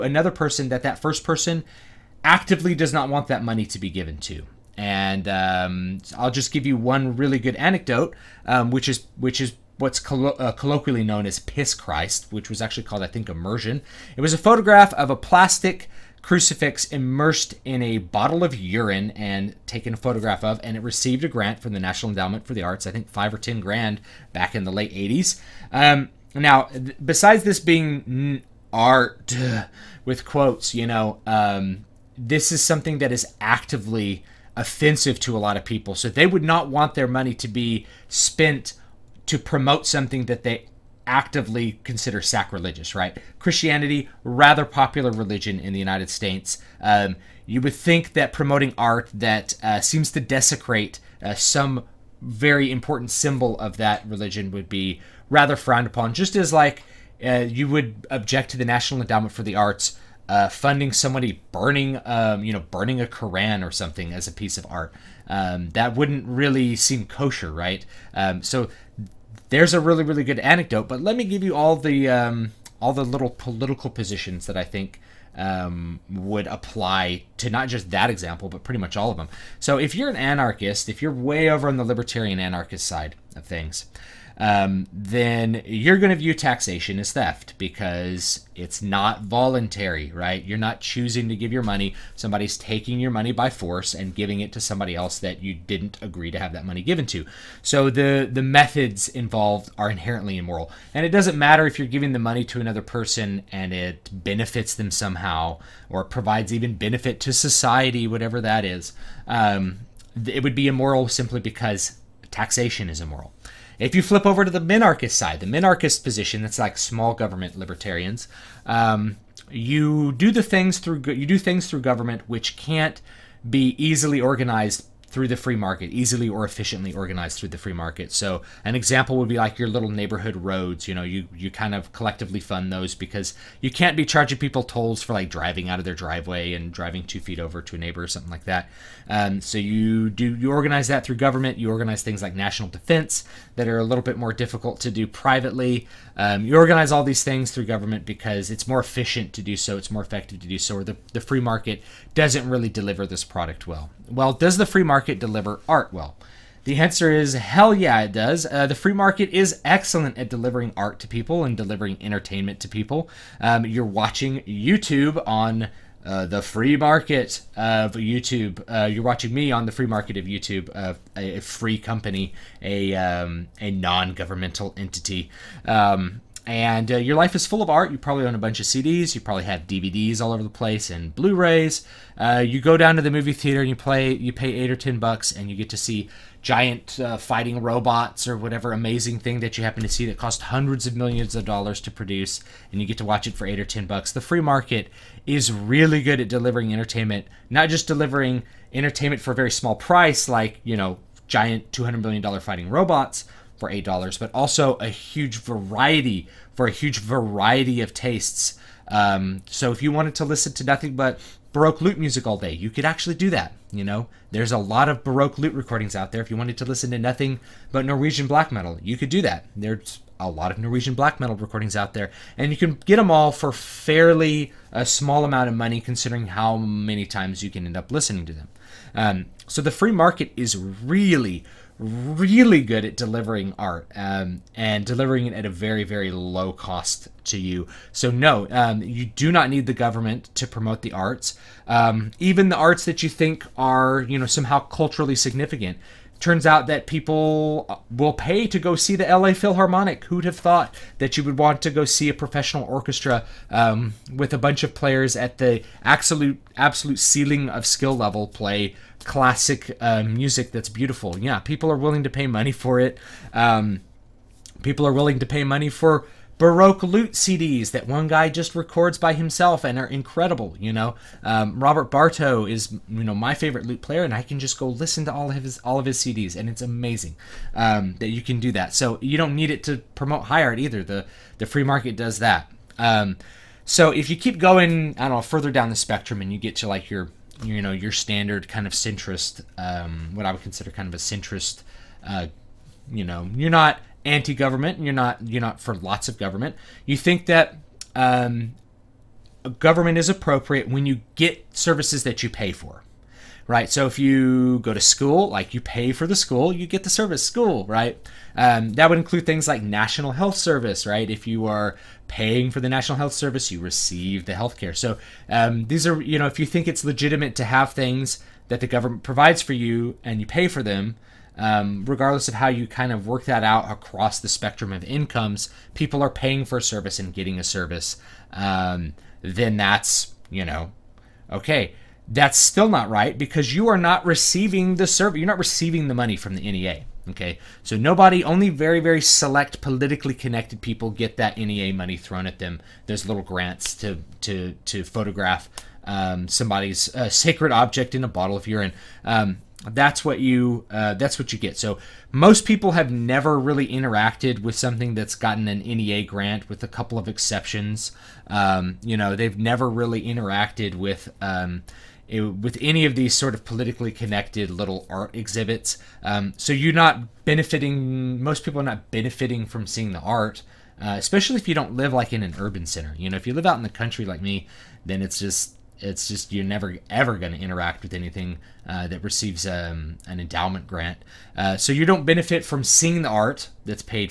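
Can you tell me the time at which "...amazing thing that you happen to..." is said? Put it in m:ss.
3:08.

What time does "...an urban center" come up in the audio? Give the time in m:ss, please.
6:12.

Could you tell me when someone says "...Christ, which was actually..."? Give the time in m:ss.
0:11.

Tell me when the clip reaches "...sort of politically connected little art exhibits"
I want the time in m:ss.
6:03.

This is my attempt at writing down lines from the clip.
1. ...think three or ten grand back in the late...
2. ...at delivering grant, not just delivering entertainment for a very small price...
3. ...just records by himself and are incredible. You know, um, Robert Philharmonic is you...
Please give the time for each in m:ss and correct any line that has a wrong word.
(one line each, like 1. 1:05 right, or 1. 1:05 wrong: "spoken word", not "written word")
1. 0:22 wrong: "five", not "three"
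2. 3:16 wrong: "entertainment", not "grant"
3. 4:28 wrong: "Barto", not "Philharmonic".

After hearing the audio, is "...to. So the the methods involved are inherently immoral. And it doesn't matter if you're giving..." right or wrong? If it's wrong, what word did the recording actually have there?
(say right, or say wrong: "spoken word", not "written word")
right.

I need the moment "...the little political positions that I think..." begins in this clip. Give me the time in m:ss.
1:12.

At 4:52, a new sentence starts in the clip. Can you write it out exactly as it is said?
Uh, you know, you're not anti-government, and you're not you're not for lots of government.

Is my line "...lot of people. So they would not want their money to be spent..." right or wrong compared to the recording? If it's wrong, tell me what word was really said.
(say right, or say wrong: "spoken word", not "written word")
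right.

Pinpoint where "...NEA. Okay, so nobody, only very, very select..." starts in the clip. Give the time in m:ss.
5:36.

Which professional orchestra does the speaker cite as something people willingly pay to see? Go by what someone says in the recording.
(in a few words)
LA Philharmonic.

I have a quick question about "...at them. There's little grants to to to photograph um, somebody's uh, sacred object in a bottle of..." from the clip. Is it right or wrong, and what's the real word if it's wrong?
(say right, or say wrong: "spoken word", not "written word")
right.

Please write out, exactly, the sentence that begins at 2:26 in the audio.
Um, you organize all these things through government because it's more efficient to do so.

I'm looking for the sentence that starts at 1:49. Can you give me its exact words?
Um, it would be immoral simply because taxation is immoral.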